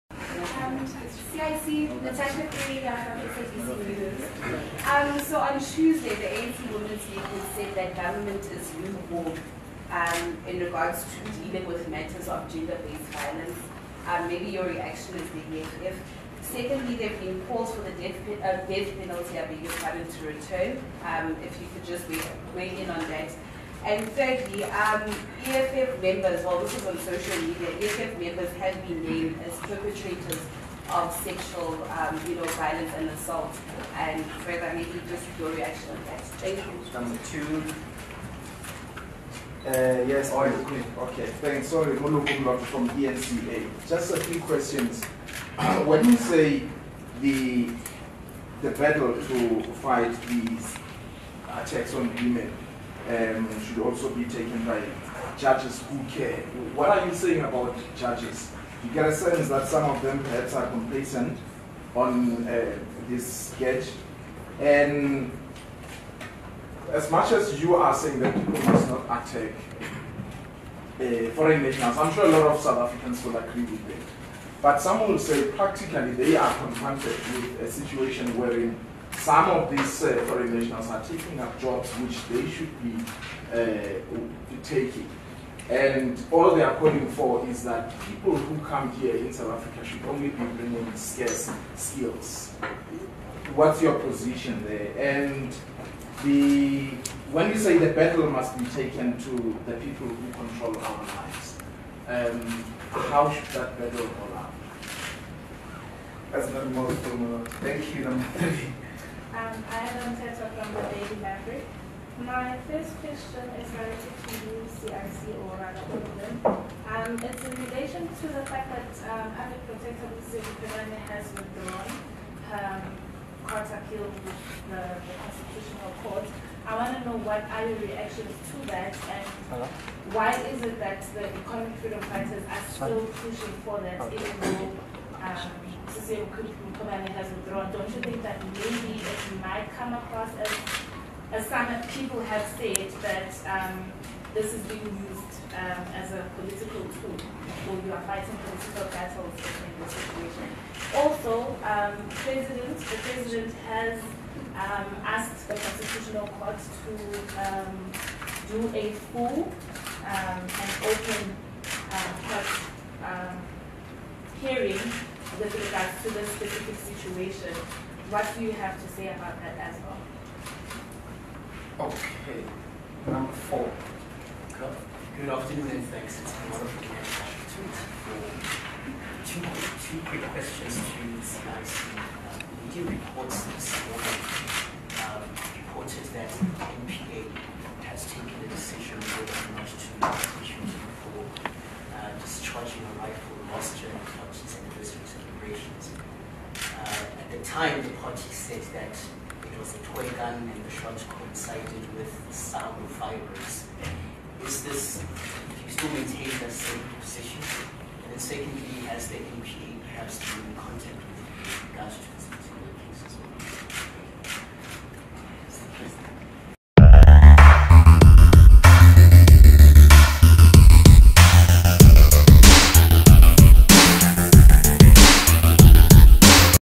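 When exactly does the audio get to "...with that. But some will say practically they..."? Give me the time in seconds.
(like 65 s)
73 s.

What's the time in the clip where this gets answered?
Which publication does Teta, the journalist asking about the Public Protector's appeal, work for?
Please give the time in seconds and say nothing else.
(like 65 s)
110 s.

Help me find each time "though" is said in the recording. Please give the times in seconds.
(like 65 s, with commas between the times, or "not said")
134 s.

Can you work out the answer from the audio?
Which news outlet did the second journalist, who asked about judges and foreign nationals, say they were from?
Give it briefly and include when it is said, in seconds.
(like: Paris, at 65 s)
eNCA, at 42 s.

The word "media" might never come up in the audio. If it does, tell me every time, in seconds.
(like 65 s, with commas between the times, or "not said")
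27 s, 182 s.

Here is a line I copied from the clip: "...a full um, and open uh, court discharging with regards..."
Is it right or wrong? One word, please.
wrong.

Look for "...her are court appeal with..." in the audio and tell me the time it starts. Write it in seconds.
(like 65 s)
122 s.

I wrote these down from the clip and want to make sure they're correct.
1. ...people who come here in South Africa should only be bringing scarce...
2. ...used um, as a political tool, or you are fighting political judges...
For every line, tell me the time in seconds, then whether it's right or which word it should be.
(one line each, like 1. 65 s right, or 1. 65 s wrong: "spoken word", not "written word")
1. 88 s right
2. 145 s wrong: "battles", not "judges".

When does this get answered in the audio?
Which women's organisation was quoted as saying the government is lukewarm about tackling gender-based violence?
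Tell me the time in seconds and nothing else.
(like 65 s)
6 s.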